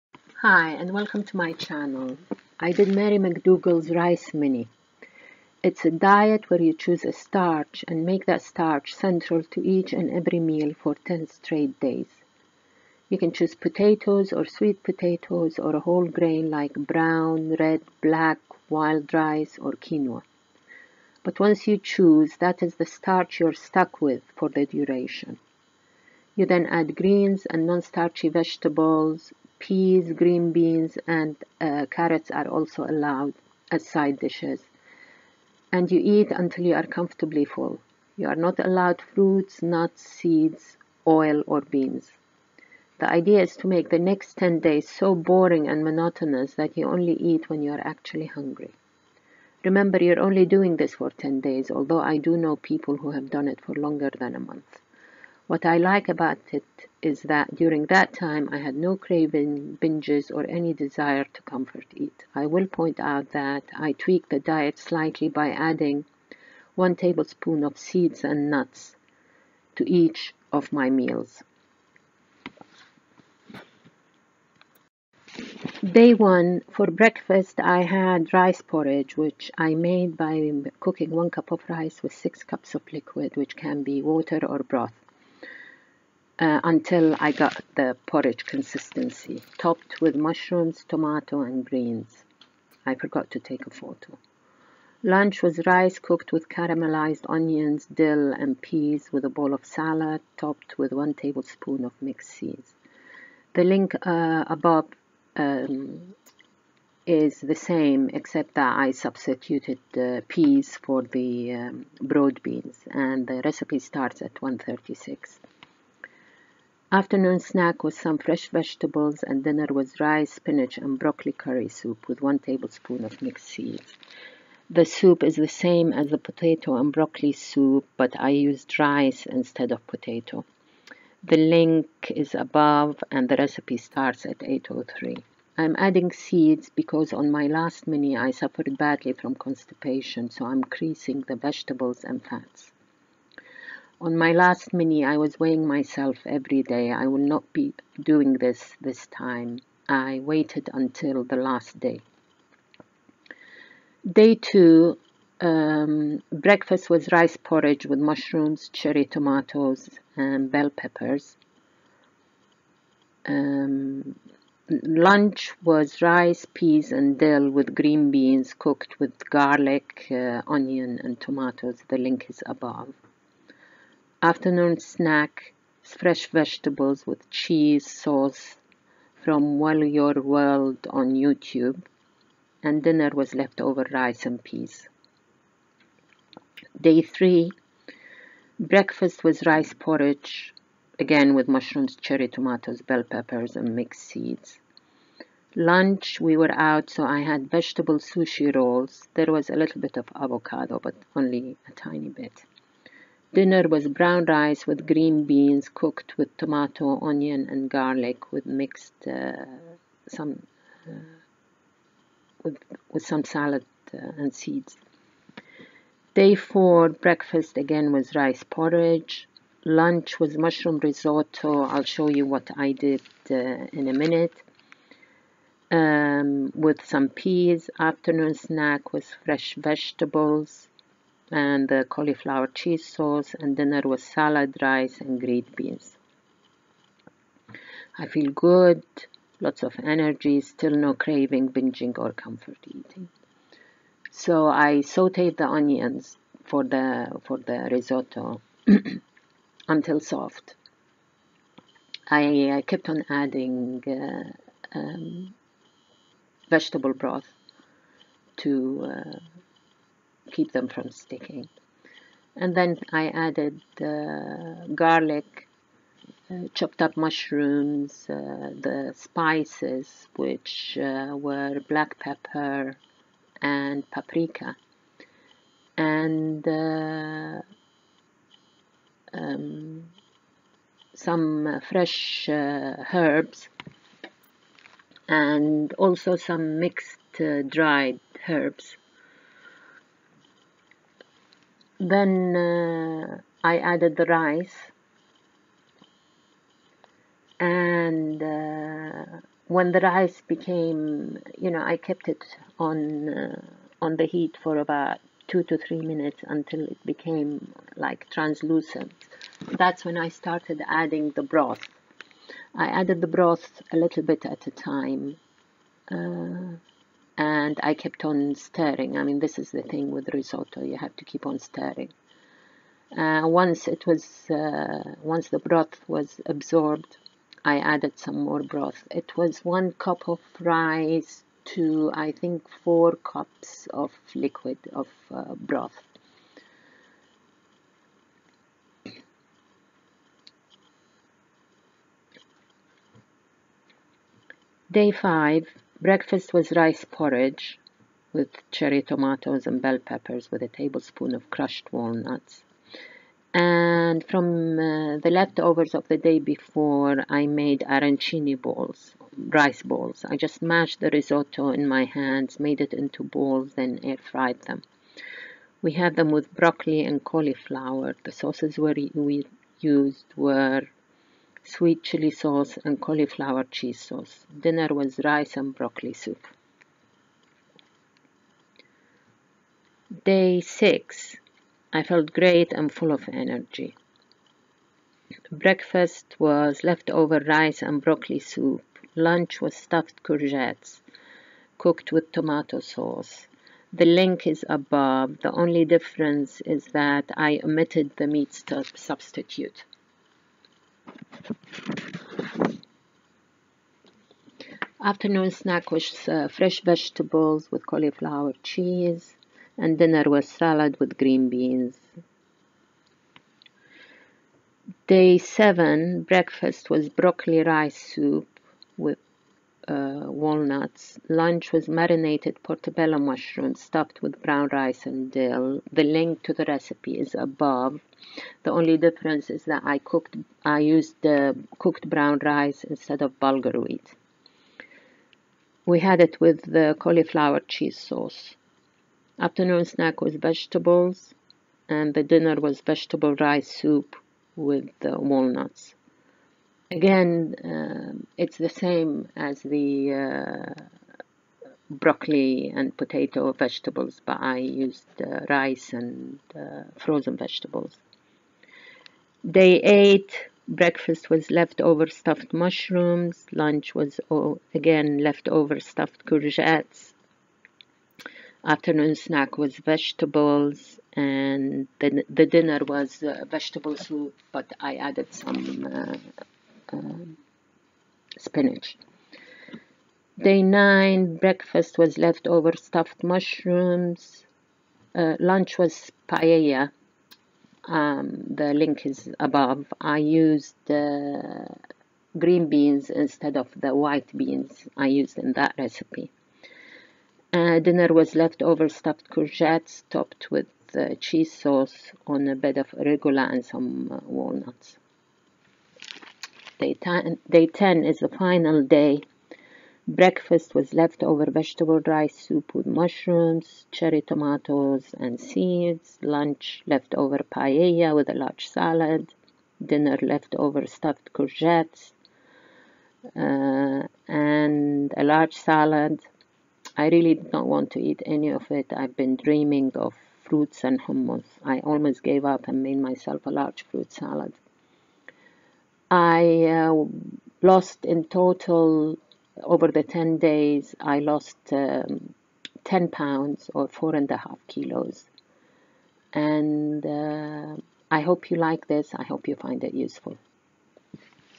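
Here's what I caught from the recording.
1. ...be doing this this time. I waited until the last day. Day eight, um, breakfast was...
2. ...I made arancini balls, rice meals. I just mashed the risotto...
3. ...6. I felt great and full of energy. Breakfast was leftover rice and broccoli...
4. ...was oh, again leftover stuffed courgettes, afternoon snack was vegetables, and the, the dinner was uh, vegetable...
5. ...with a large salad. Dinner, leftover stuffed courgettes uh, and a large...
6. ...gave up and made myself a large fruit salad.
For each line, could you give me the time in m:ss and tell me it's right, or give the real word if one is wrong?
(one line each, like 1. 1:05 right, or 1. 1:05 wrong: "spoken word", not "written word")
1. 2:27 wrong: "two", not "eight"
2. 5:57 wrong: "balls", not "meals"
3. 6:20 right
4. 7:43 right
5. 8:37 right
6. 8:52 right.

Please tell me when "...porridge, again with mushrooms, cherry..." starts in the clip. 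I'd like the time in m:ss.
3:09.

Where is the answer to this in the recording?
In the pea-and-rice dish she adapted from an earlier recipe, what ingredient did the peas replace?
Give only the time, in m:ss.
1:52.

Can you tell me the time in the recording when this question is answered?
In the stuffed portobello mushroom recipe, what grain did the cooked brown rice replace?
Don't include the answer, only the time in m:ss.
7:13.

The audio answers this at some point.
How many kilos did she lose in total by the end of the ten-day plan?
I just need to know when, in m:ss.
9:03.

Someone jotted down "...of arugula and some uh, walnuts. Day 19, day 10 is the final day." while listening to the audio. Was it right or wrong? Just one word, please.
wrong.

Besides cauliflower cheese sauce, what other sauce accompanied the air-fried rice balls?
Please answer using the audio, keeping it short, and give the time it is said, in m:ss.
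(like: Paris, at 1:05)
Sweet chili sauce, at 6:11.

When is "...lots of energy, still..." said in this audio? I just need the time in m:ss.
3:59.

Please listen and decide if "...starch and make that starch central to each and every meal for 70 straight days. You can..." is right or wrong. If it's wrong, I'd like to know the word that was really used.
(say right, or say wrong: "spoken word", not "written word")
wrong: "10", not "70".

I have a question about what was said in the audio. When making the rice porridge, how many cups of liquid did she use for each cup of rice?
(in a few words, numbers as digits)
6.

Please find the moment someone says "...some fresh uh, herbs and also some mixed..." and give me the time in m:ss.
4:40.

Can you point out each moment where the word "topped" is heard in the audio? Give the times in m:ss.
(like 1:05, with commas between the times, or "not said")
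1:29, 1:40, 8:19.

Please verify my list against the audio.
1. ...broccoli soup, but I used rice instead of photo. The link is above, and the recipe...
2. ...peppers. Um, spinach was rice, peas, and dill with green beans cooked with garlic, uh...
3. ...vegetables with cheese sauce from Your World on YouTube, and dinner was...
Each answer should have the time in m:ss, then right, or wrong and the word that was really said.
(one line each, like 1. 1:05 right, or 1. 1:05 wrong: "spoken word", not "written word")
1. 2:06 wrong: "potato", not "photo"
2. 2:40 wrong: "lunch", not "spinach"
3. 2:56 right.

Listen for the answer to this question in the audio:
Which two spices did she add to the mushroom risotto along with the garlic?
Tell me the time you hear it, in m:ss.
4:31.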